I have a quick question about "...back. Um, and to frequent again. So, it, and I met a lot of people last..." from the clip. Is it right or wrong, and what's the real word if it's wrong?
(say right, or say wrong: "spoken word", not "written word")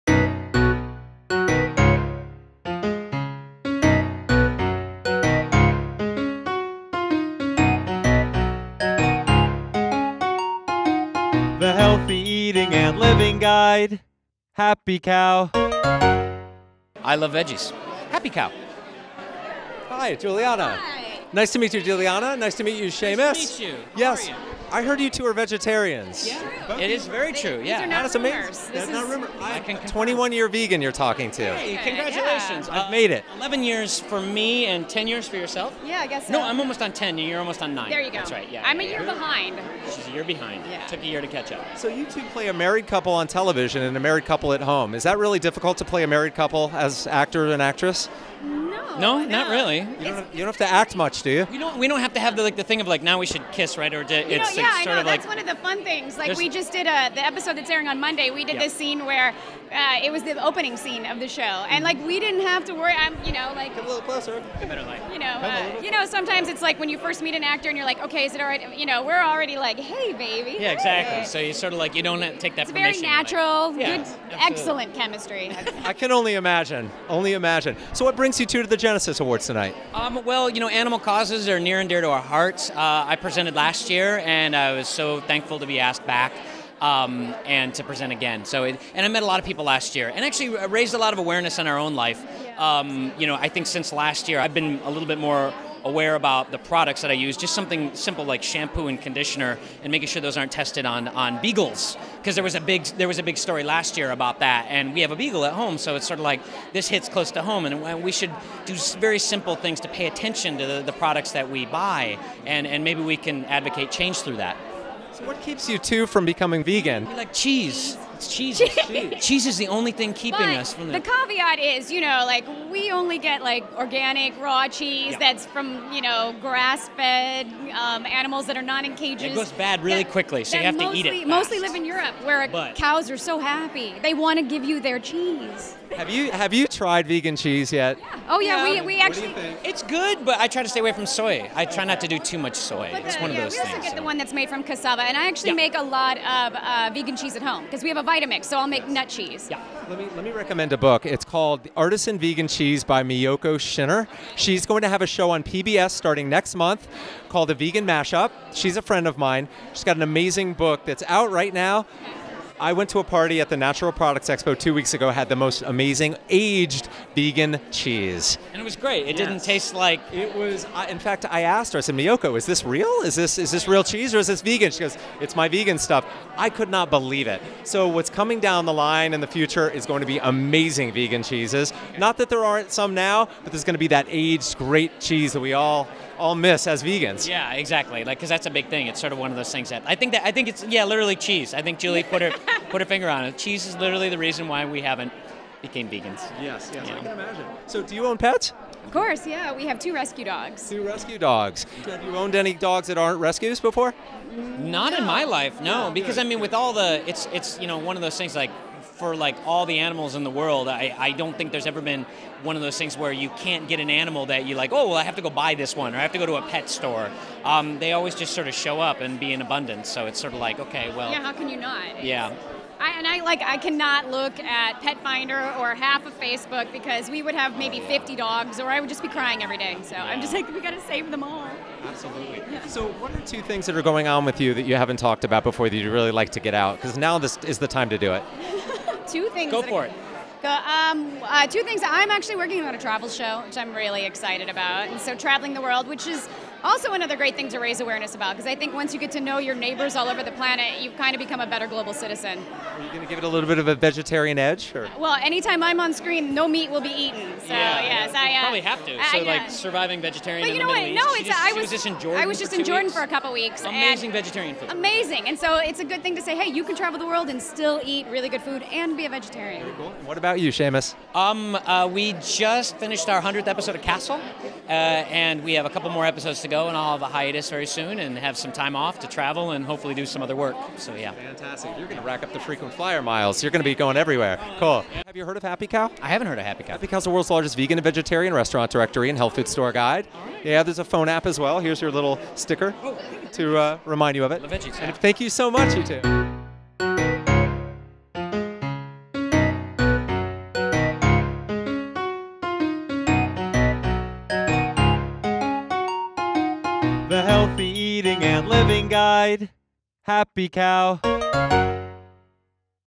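wrong: "present", not "frequent".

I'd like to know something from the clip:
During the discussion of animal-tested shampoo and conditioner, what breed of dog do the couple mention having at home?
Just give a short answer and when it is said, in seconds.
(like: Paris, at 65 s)
beagle, at 104 s.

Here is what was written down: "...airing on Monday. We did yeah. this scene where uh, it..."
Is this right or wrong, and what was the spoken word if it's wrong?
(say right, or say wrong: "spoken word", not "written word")
right.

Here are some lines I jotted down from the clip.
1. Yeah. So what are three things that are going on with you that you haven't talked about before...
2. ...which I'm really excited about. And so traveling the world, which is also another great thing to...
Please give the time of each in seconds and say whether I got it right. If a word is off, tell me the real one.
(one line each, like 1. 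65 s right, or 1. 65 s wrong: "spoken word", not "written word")
1. 232 s wrong: "two", not "three"
2. 243 s right.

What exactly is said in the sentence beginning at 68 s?
You know, we're already like, hey, baby.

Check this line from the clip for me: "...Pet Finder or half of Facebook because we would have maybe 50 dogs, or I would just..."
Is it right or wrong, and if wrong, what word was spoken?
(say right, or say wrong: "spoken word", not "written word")
right.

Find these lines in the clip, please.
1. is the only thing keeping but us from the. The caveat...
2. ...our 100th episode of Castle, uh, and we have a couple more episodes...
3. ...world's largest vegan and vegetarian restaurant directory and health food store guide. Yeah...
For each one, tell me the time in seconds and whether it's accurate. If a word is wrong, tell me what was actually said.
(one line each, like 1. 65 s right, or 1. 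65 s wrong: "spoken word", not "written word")
1. 119 s right
2. 273 s right
3. 287 s right.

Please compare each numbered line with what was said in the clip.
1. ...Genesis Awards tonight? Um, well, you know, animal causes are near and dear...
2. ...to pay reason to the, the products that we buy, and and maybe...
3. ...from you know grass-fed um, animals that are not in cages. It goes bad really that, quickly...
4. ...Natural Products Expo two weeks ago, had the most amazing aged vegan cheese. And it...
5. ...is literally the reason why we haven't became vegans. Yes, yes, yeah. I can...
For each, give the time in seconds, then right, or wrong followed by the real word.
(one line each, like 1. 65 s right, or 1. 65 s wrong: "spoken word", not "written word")
1. 78 s right
2. 109 s wrong: "attention", not "reason"
3. 125 s right
4. 163 s right
5. 193 s right.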